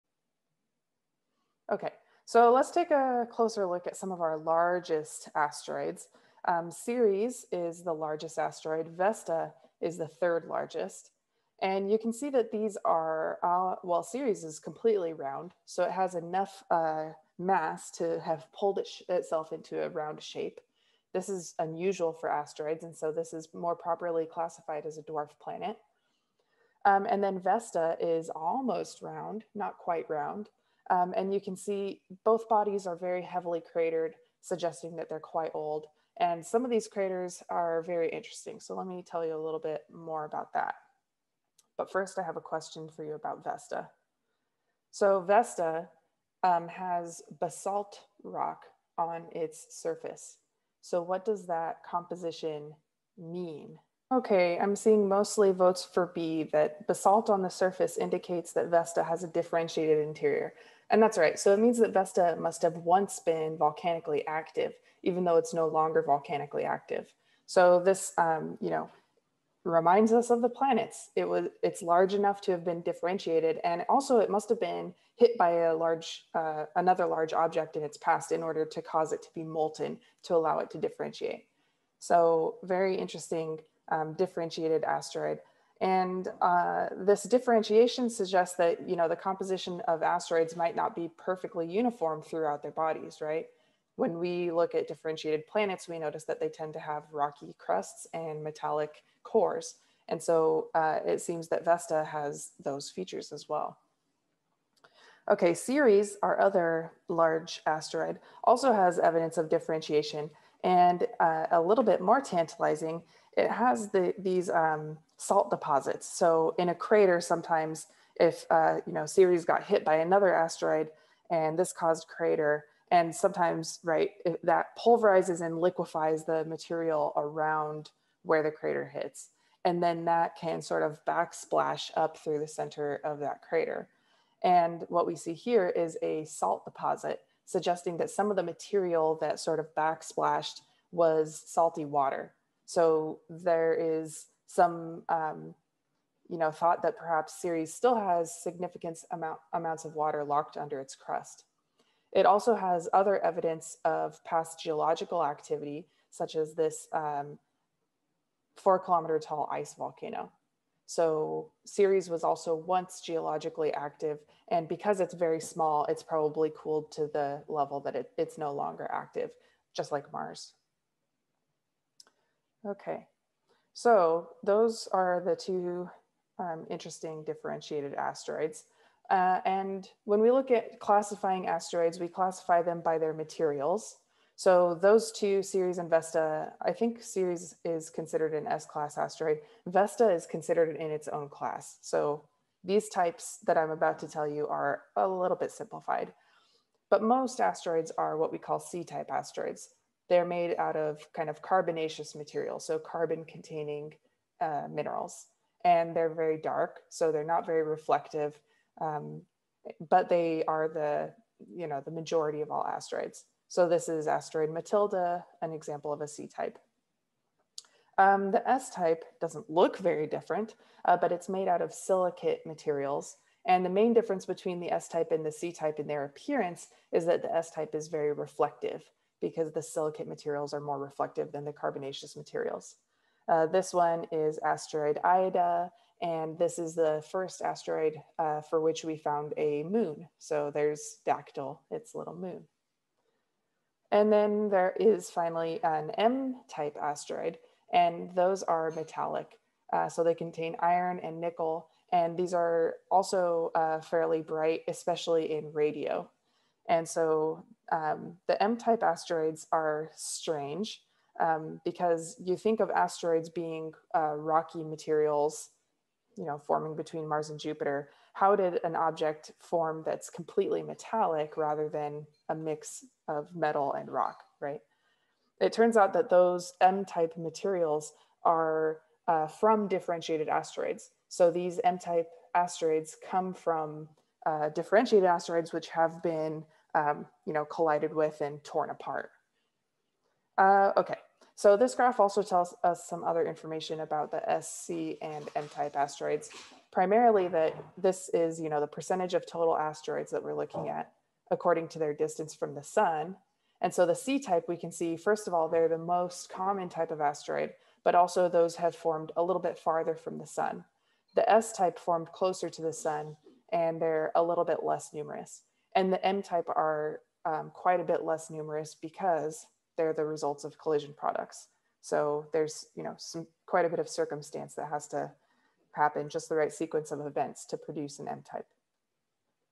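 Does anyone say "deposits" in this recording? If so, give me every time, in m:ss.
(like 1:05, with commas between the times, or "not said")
1:55, 2:16.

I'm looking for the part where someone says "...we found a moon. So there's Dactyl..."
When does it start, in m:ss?
3:58.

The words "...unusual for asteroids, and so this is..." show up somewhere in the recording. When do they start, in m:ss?
0:21.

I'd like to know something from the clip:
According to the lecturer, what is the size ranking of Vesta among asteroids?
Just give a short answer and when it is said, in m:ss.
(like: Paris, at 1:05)
third largest, at 0:10.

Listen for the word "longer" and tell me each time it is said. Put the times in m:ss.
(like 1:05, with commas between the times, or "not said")
1:05, 2:48.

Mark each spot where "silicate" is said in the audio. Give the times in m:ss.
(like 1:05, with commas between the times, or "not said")
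3:41, 3:49.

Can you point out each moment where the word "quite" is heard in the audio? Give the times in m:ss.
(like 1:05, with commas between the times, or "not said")
0:29, 0:35, 5:17, 5:23.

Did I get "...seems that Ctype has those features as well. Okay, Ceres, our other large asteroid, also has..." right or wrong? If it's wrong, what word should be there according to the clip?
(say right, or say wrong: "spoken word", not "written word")
wrong: "Vesta", not "Ctype".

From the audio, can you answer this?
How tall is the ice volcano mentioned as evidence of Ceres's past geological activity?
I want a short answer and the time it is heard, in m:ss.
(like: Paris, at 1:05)
4 kilometers, at 2:38.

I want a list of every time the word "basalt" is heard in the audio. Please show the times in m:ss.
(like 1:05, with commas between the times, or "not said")
0:47, 0:56.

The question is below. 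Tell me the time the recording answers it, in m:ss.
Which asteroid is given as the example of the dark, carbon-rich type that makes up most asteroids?
3:34.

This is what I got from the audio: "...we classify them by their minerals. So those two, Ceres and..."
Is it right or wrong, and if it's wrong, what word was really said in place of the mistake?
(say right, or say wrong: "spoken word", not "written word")
wrong: "materials", not "minerals".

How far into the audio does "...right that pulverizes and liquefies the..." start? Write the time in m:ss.
2:03.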